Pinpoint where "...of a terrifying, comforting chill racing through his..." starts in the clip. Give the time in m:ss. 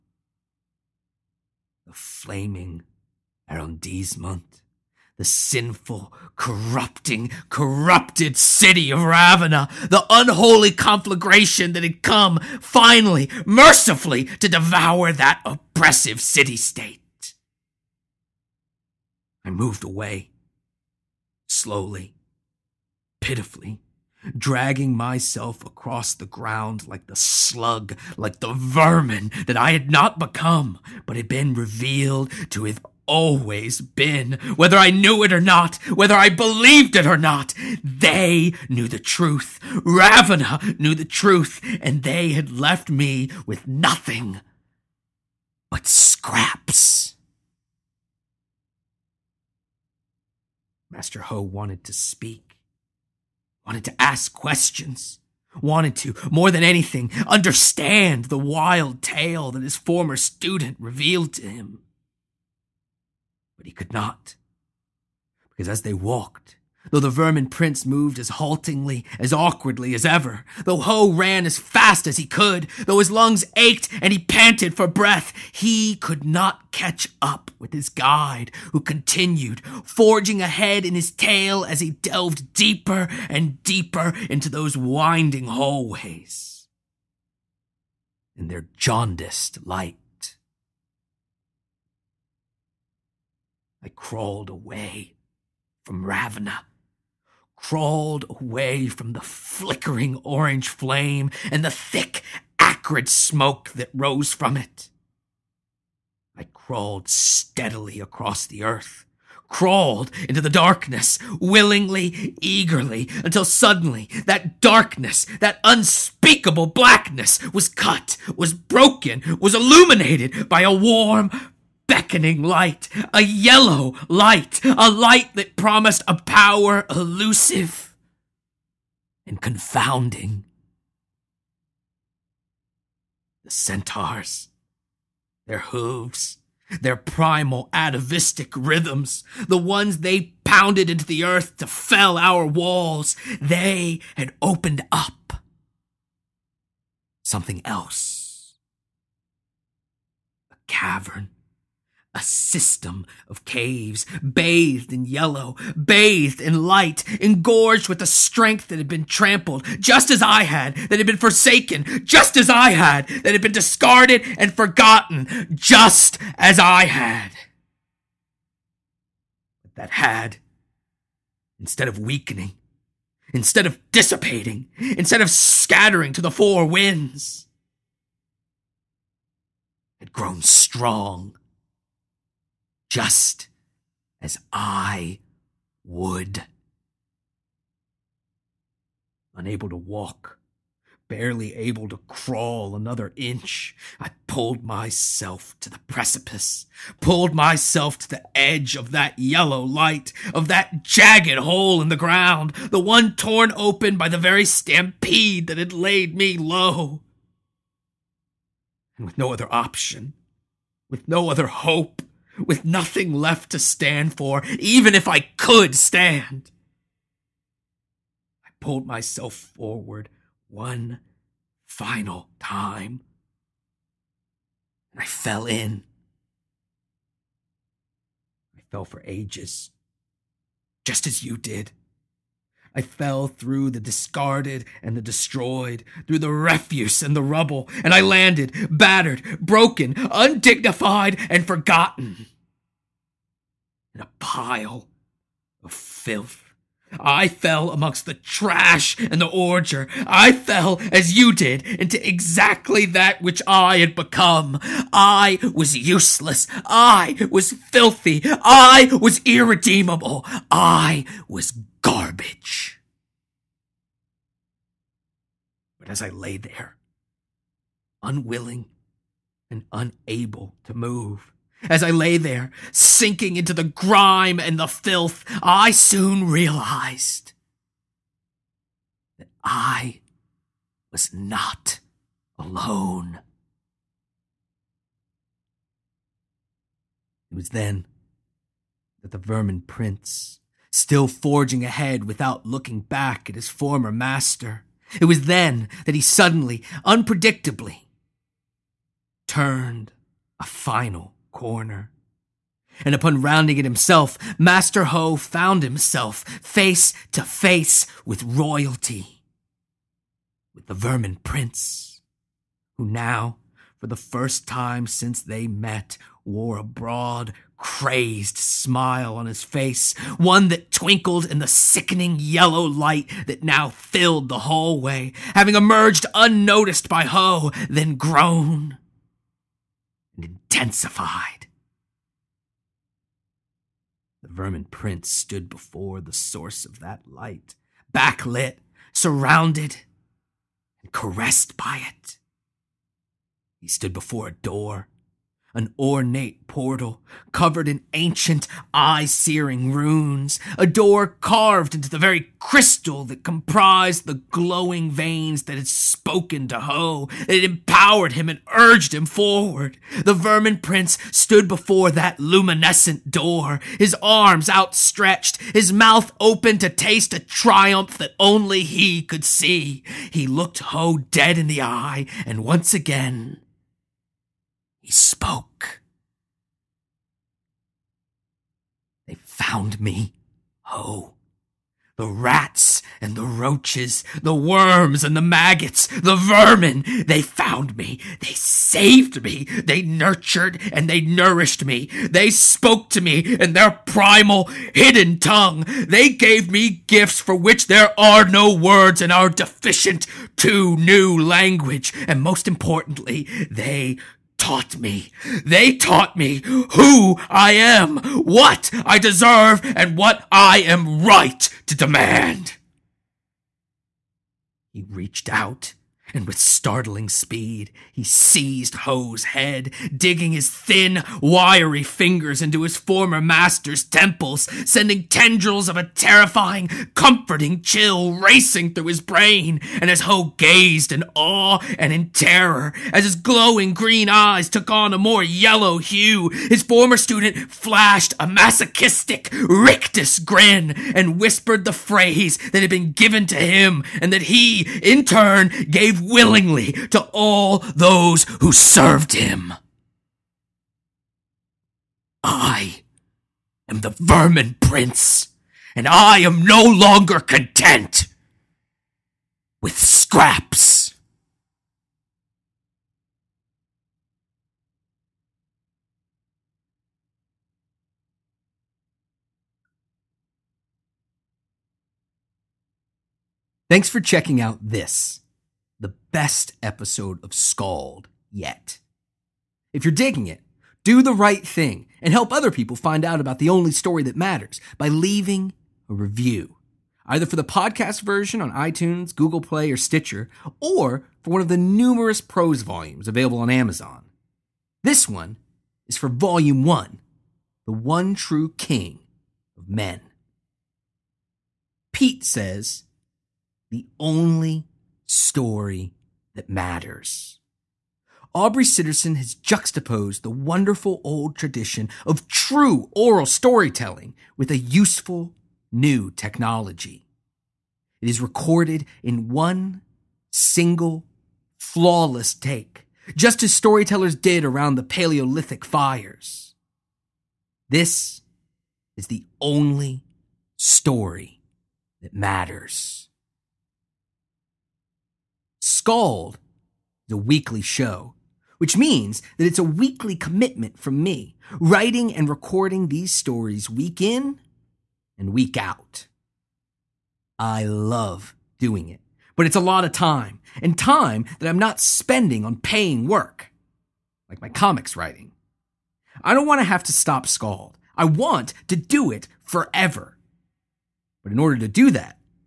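7:05.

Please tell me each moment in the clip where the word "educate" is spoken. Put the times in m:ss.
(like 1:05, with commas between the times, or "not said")
not said.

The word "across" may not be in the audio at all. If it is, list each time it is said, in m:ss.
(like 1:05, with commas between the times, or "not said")
0:25, 1:47.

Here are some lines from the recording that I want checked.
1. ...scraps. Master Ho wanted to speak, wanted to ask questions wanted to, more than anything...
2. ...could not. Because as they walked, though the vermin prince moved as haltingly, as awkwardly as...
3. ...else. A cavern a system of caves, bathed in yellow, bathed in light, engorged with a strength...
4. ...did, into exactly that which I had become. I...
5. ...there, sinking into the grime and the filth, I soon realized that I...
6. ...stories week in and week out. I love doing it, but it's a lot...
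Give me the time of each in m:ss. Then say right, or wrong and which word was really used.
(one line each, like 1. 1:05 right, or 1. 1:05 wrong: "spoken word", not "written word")
1. 0:45 right
2. 1:03 right
3. 2:27 right
4. 4:11 right
5. 4:32 right
6. 9:03 right.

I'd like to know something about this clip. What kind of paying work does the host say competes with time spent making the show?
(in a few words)
comics writing.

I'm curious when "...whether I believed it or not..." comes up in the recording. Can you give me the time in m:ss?
0:35.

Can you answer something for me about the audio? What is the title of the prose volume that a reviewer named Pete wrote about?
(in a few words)
The One True King of Men.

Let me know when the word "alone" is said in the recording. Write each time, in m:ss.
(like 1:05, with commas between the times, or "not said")
4:42.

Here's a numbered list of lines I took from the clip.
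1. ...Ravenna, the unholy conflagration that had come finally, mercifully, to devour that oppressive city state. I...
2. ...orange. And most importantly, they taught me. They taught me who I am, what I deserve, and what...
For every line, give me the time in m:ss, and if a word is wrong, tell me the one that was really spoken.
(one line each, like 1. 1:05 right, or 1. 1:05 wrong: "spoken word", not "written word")
1. 0:09 right
2. 6:41 wrong: "language", not "orange".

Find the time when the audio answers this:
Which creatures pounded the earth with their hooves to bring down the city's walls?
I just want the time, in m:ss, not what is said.
2:13.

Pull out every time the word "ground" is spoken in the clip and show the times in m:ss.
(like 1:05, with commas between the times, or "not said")
0:26, 3:21.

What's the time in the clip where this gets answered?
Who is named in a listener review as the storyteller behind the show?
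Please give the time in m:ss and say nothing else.
8:28.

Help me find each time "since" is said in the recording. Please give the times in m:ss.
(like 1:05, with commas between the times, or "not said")
5:14.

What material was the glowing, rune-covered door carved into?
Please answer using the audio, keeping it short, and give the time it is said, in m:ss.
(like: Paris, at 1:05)
crystal, at 5:52.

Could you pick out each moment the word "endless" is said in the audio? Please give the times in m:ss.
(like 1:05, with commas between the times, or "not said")
not said.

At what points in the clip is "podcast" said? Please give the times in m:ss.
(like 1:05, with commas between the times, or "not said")
8:07.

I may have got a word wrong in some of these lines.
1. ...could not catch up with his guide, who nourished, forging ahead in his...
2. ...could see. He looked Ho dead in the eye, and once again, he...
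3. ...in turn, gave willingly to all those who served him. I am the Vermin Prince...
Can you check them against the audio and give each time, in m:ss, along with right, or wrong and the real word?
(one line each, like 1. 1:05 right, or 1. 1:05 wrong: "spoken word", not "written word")
1. 1:15 wrong: "continued", not "nourished"
2. 6:09 right
3. 7:24 right.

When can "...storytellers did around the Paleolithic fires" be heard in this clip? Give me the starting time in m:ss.
8:43.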